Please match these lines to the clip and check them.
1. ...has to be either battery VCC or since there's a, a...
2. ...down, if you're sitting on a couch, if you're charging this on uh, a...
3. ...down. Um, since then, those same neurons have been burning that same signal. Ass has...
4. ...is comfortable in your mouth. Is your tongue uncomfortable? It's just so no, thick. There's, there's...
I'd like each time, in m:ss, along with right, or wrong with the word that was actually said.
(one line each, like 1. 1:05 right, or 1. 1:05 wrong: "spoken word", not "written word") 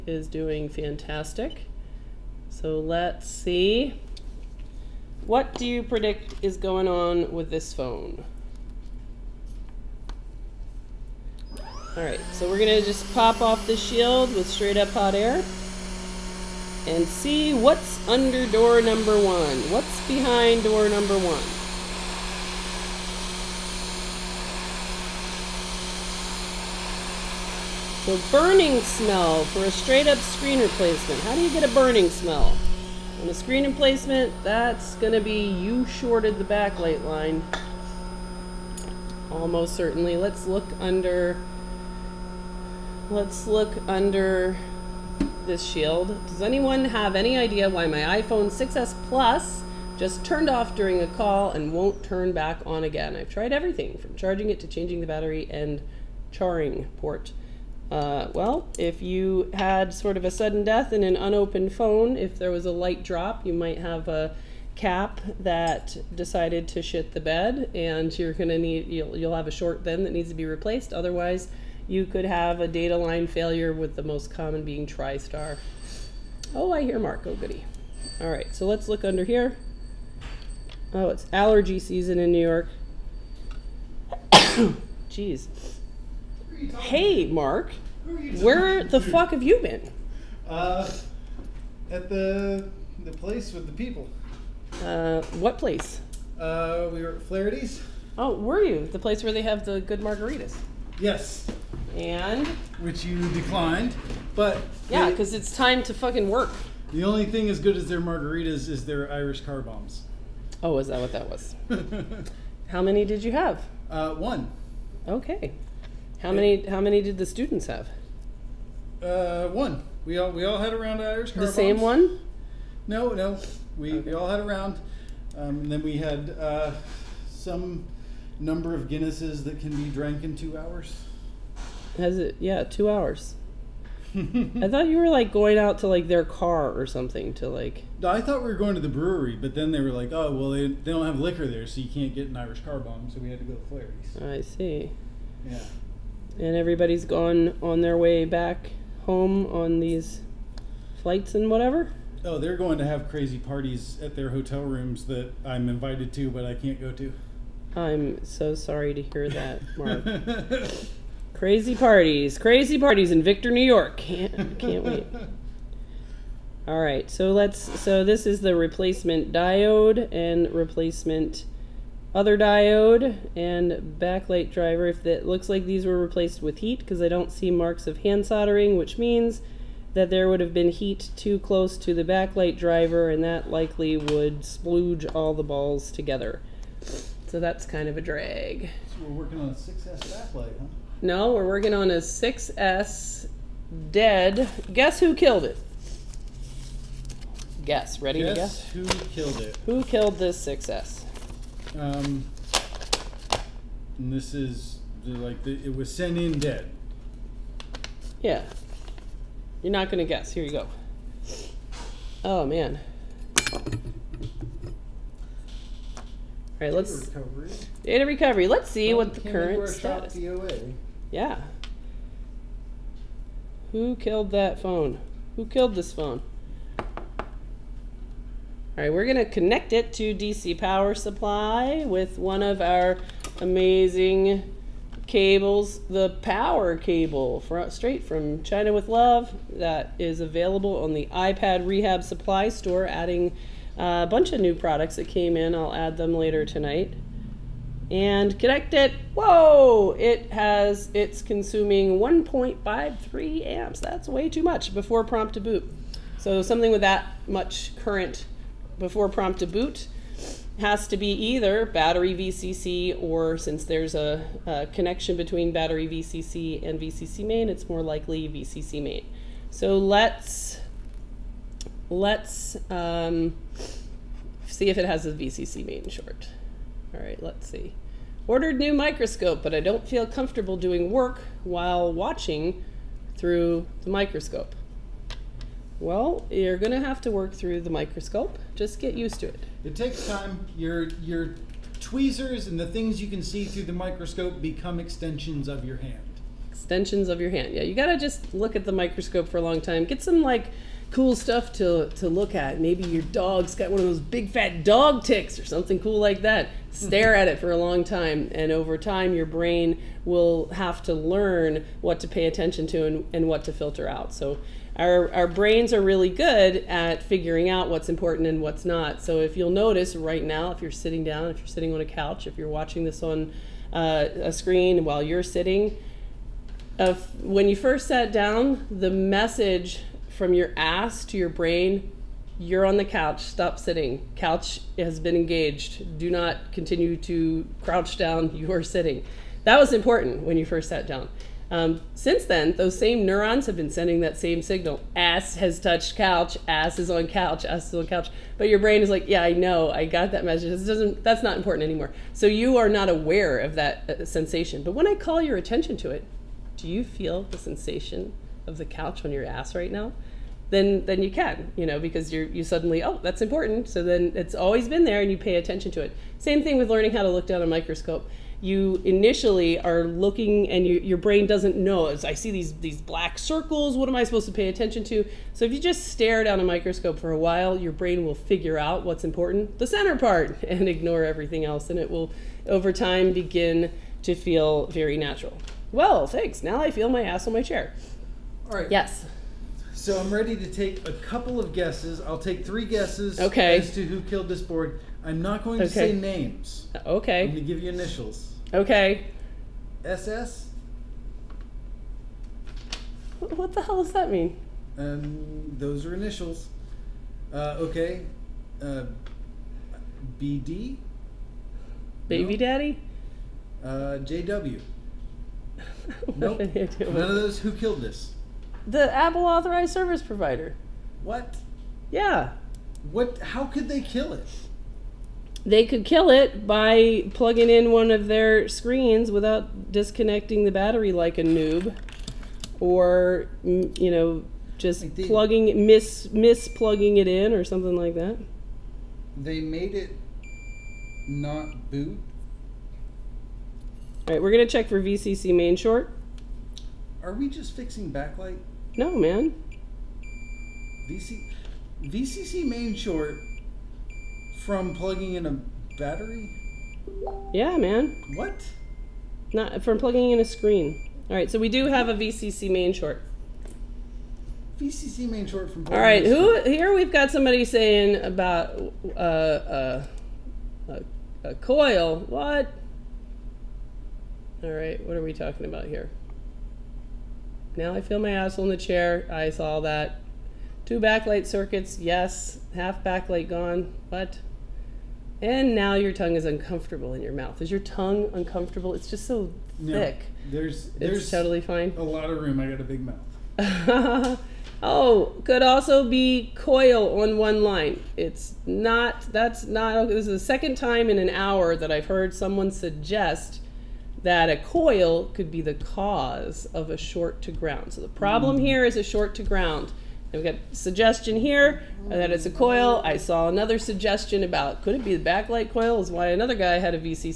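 1. 4:20 right
2. 5:21 wrong: "watching", not "charging"
3. 5:40 wrong: "sending", not "burning"
4. 8:06 wrong: "uncomfortable", not "comfortable".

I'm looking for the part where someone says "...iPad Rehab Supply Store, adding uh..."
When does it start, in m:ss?
4:01.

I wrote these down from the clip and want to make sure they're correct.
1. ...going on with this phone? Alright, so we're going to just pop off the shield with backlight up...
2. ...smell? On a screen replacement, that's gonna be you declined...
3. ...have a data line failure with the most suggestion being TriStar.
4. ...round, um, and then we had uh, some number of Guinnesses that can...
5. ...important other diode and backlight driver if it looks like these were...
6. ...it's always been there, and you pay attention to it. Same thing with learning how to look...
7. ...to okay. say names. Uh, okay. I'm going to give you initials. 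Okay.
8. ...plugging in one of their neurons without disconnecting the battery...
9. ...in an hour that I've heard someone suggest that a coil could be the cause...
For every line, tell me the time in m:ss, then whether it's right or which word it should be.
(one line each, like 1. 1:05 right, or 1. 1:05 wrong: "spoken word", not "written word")
1. 0:06 wrong: "straight", not "backlight"
2. 0:32 wrong: "shorted", not "declined"
3. 1:12 wrong: "common", not "suggestion"
4. 2:04 right
5. 2:50 wrong: "replacement", not "important"
6. 6:04 right
7. 6:35 right
8. 7:07 wrong: "screens", not "neurons"
9. 8:20 right.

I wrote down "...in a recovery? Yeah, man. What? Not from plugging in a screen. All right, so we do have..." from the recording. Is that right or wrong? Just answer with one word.
wrong.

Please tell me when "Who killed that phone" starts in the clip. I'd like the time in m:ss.
3:43.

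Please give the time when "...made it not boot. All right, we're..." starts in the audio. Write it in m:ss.
7:19.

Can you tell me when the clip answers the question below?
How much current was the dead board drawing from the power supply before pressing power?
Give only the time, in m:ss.
4:11.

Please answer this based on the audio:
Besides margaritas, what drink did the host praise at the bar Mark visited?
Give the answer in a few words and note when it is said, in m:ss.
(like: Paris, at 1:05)
Irish car bombs, at 1:49.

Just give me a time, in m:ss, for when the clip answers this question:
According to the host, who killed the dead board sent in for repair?
6:58.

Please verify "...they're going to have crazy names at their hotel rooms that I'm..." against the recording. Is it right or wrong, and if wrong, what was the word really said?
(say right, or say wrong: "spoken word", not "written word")
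wrong: "parties", not "names".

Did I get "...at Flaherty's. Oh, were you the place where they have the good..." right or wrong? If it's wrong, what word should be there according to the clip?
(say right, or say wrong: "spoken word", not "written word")
right.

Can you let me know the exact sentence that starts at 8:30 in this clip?
we have got suggestion here uh, that it's a coil.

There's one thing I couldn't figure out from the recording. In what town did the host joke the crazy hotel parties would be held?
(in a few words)
Victor, New York.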